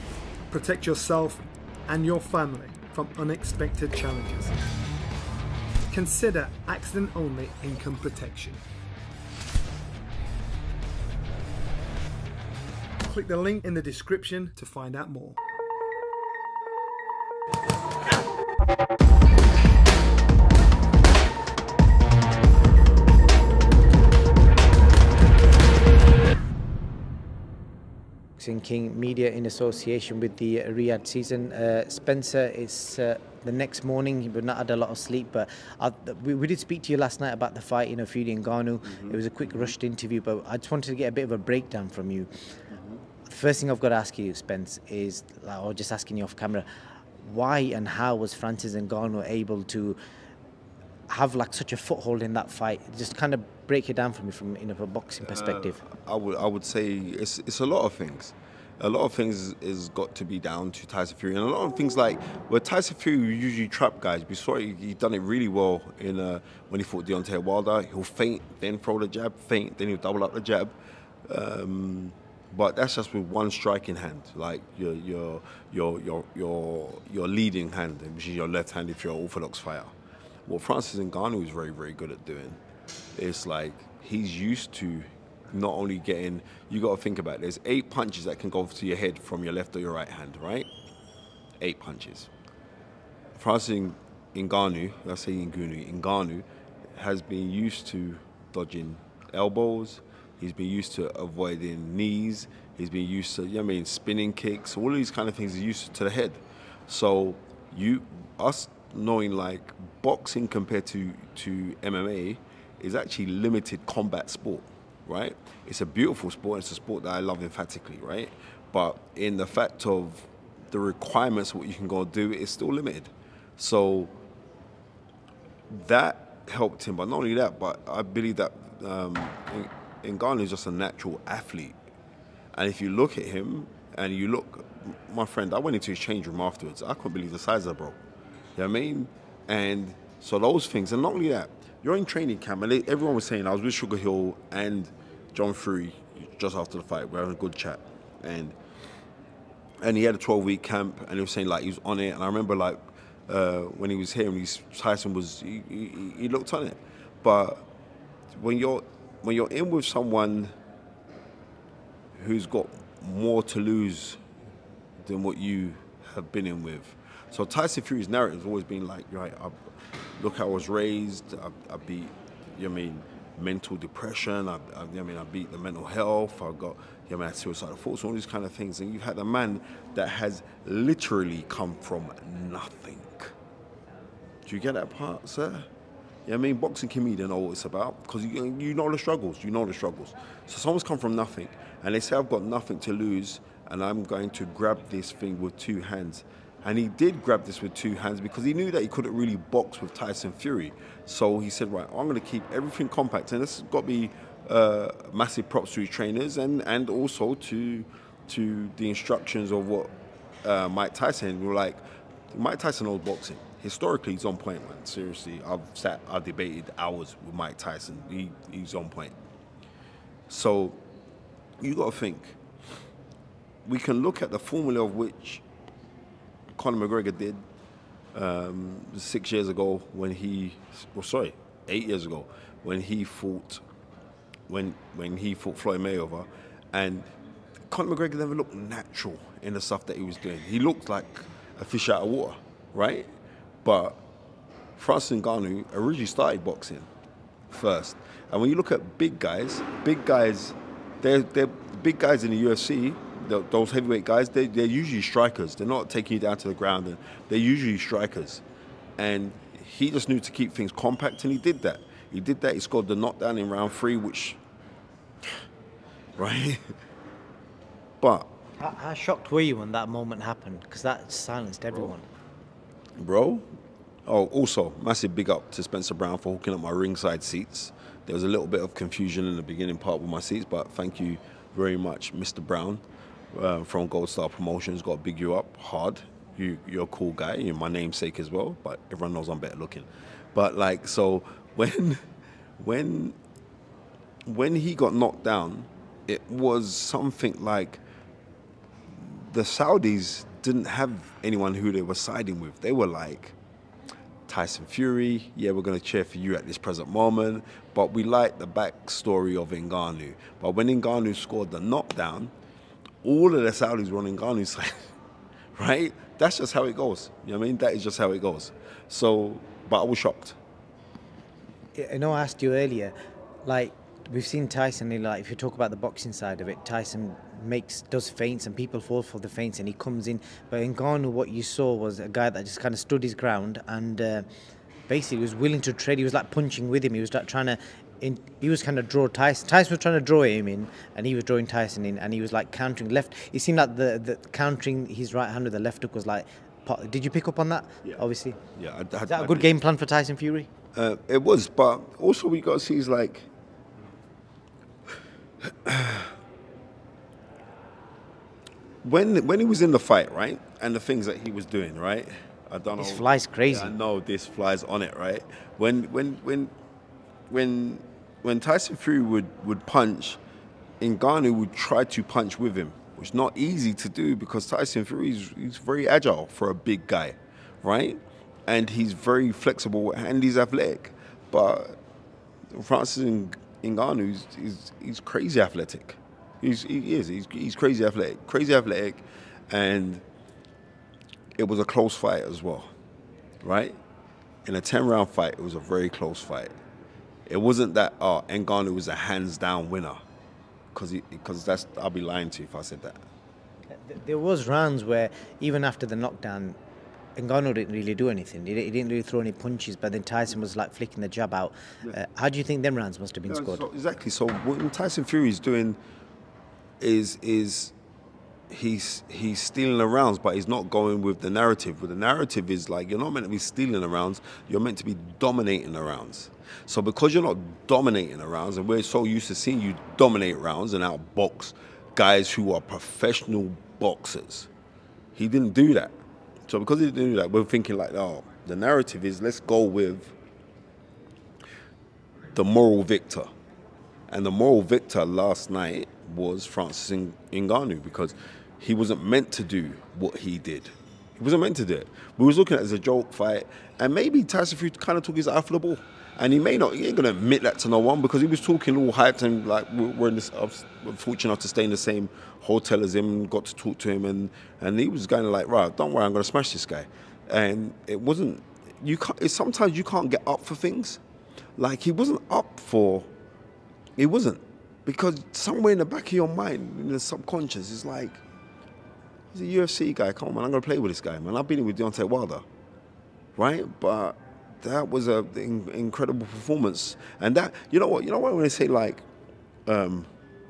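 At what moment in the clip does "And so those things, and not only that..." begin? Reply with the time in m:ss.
2:19.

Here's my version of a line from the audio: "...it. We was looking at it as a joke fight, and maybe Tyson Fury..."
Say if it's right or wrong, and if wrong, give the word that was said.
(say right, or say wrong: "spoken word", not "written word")
right.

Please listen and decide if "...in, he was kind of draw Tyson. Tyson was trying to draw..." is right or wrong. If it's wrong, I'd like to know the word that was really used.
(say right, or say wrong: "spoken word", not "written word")
right.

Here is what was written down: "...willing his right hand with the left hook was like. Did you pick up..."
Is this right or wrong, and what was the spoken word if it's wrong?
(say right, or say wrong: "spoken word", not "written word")
wrong: "countering", not "willing".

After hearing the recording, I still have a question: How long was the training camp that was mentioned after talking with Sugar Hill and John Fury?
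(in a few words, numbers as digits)
12 weeks.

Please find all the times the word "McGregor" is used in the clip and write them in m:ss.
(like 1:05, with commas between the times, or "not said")
3:46, 3:57.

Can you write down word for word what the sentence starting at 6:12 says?
which is not easy to do because Tyson Fury is he's very agile for a big guy, right?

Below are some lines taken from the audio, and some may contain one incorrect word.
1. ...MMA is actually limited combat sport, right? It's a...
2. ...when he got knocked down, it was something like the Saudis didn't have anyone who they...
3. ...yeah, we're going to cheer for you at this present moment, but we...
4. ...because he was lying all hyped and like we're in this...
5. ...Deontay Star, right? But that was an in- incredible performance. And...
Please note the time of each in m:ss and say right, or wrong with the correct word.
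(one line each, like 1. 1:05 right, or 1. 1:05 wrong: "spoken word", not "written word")
1. 1:51 right
2. 4:54 right
3. 5:05 right
4. 7:38 wrong: "talking", not "lying"
5. 8:01 wrong: "Wilder", not "Star".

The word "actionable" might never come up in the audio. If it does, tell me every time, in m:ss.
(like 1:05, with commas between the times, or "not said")
not said.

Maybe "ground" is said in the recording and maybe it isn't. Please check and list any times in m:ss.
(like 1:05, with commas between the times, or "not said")
4:16, 5:33.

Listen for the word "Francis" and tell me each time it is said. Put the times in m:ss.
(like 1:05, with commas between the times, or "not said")
0:48, 1:20, 1:33, 4:04, 6:22, 7:26.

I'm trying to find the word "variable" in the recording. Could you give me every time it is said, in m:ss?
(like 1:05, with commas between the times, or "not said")
not said.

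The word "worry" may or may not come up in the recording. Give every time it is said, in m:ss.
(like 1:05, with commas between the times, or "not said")
7:45.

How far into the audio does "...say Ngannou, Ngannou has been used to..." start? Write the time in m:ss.
1:35.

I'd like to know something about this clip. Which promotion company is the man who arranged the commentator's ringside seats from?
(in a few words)
Gold Star Promotions.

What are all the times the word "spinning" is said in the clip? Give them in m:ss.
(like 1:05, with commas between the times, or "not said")
1:43.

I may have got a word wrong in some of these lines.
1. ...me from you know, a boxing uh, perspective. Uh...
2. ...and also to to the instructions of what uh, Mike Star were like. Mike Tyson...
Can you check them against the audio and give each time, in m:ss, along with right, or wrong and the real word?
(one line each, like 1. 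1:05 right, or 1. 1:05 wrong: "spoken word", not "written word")
1. 0:54 right
2. 3:26 wrong: "Tyson", not "Star".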